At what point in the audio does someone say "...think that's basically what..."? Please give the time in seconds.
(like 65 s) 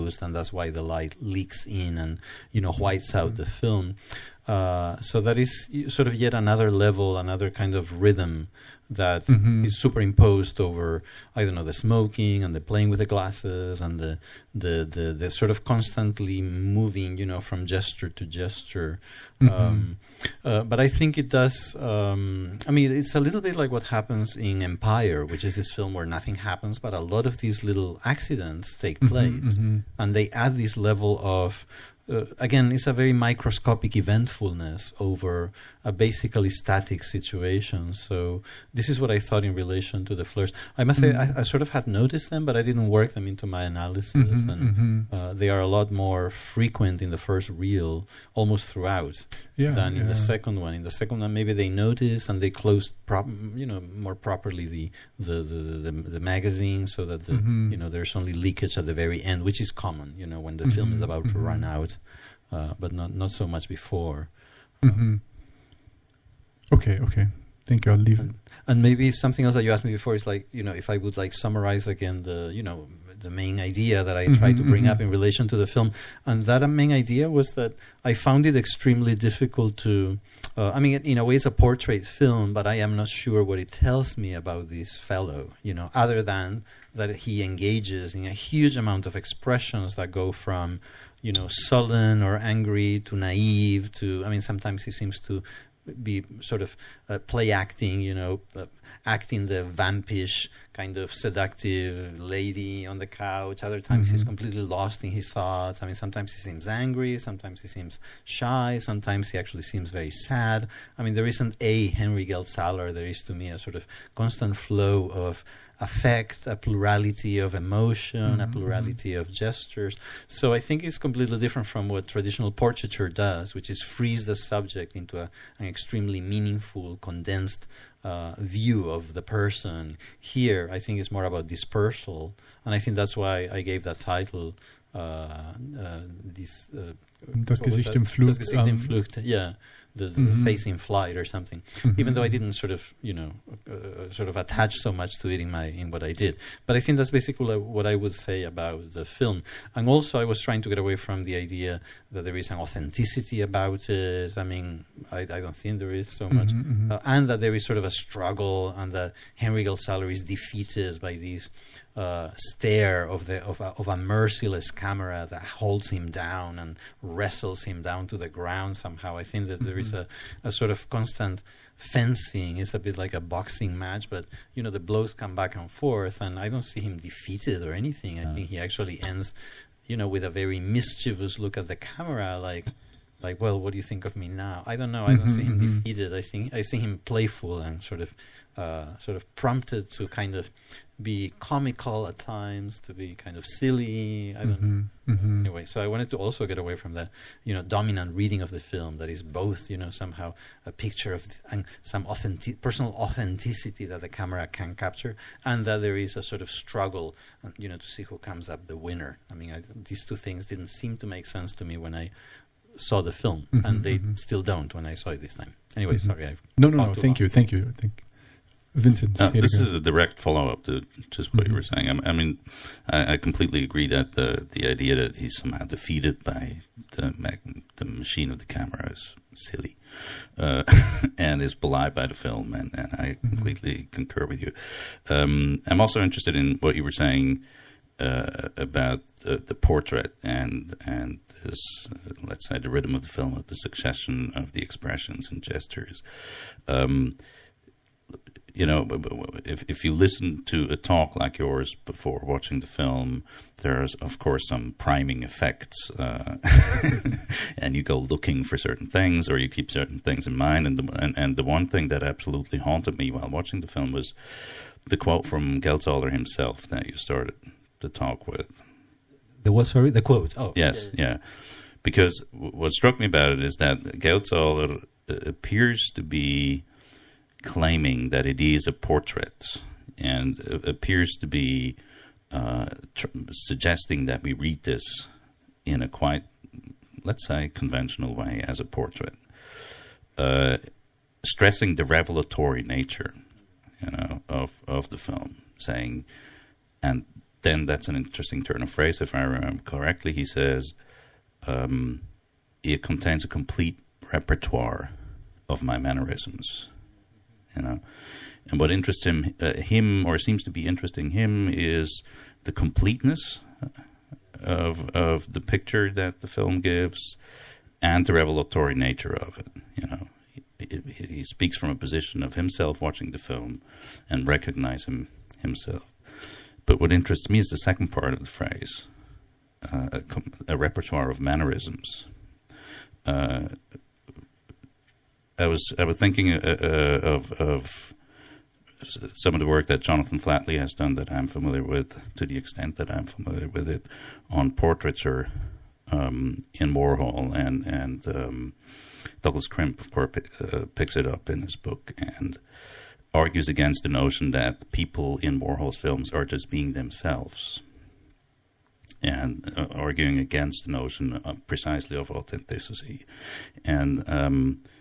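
146 s.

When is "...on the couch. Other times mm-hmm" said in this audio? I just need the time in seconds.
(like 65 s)
102 s.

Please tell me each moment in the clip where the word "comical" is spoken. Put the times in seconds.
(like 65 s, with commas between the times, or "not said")
191 s.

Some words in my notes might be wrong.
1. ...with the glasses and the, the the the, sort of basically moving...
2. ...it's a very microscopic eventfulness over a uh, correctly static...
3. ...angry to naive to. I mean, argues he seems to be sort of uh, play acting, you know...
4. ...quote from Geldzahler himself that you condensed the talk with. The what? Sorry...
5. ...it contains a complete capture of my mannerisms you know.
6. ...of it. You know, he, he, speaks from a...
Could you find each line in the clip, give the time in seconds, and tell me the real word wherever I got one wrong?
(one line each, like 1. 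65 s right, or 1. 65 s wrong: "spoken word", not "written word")
1. 12 s wrong: "constantly", not "basically"
2. 32 s wrong: "basically", not "correctly"
3. 92 s wrong: "sometimes", not "argues"
4. 264 s wrong: "started", not "condensed"
5. 302 s wrong: "repertoire", not "capture"
6. 319 s right.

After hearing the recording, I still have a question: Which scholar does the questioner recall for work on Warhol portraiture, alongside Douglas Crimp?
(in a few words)
Jonathan Flatley.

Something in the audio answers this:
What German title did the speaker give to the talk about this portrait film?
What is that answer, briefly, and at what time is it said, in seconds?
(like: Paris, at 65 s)
Das Gesicht im Flug, at 137 s.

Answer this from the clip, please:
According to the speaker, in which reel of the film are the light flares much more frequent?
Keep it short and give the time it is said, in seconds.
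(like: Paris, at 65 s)
The first reel, at 47 s.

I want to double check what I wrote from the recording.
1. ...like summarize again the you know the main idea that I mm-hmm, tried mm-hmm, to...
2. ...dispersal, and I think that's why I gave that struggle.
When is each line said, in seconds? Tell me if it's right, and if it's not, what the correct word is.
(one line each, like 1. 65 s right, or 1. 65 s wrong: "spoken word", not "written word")
1. 71 s right
2. 131 s wrong: "title", not "struggle".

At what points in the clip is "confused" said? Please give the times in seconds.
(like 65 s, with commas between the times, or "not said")
not said.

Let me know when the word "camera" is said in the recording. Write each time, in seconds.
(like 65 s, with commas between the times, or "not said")
164 s, 181 s, 204 s, 228 s.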